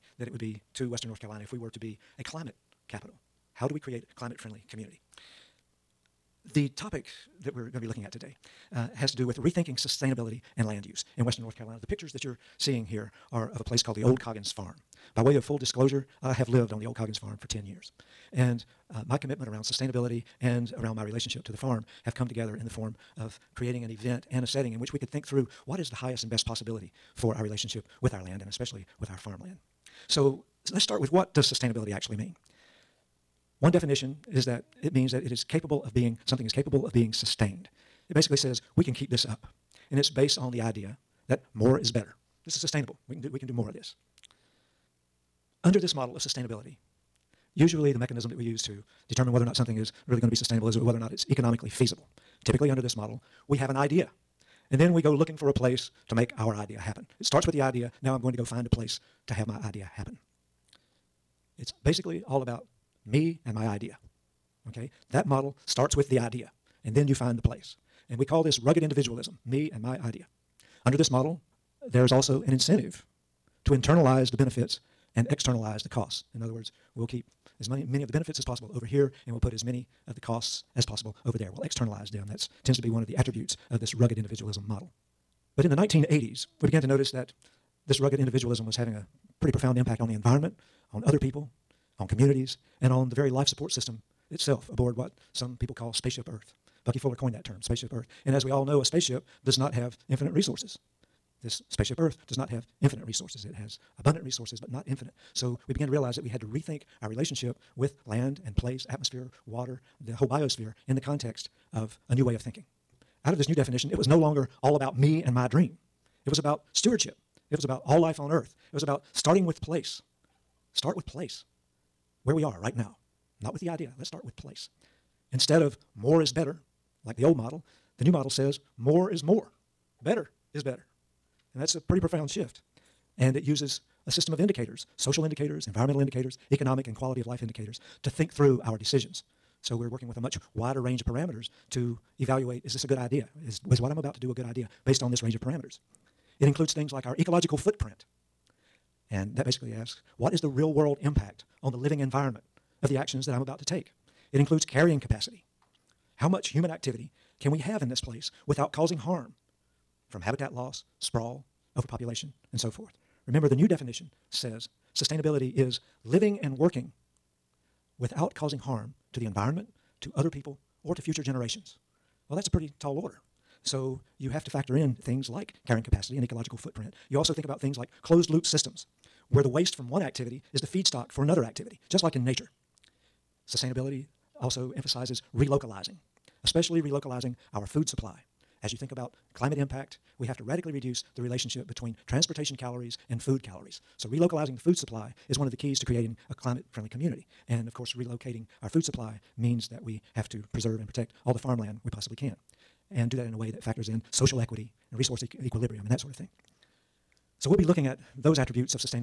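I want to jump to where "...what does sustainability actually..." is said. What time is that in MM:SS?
00:31.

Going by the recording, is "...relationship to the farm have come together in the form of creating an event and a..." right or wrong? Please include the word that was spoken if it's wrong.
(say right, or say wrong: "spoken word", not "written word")
right.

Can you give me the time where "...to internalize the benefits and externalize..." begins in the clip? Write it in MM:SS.
01:13.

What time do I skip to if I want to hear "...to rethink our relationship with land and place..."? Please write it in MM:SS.
01:46.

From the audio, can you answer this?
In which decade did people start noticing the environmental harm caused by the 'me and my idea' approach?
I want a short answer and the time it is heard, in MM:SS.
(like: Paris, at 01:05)
1980s, at 01:25.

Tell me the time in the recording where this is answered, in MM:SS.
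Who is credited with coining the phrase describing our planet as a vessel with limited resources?
01:36.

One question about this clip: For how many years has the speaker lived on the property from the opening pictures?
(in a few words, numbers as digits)
10.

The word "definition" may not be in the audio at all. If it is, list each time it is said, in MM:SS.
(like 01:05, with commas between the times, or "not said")
00:33, 01:53, 02:43.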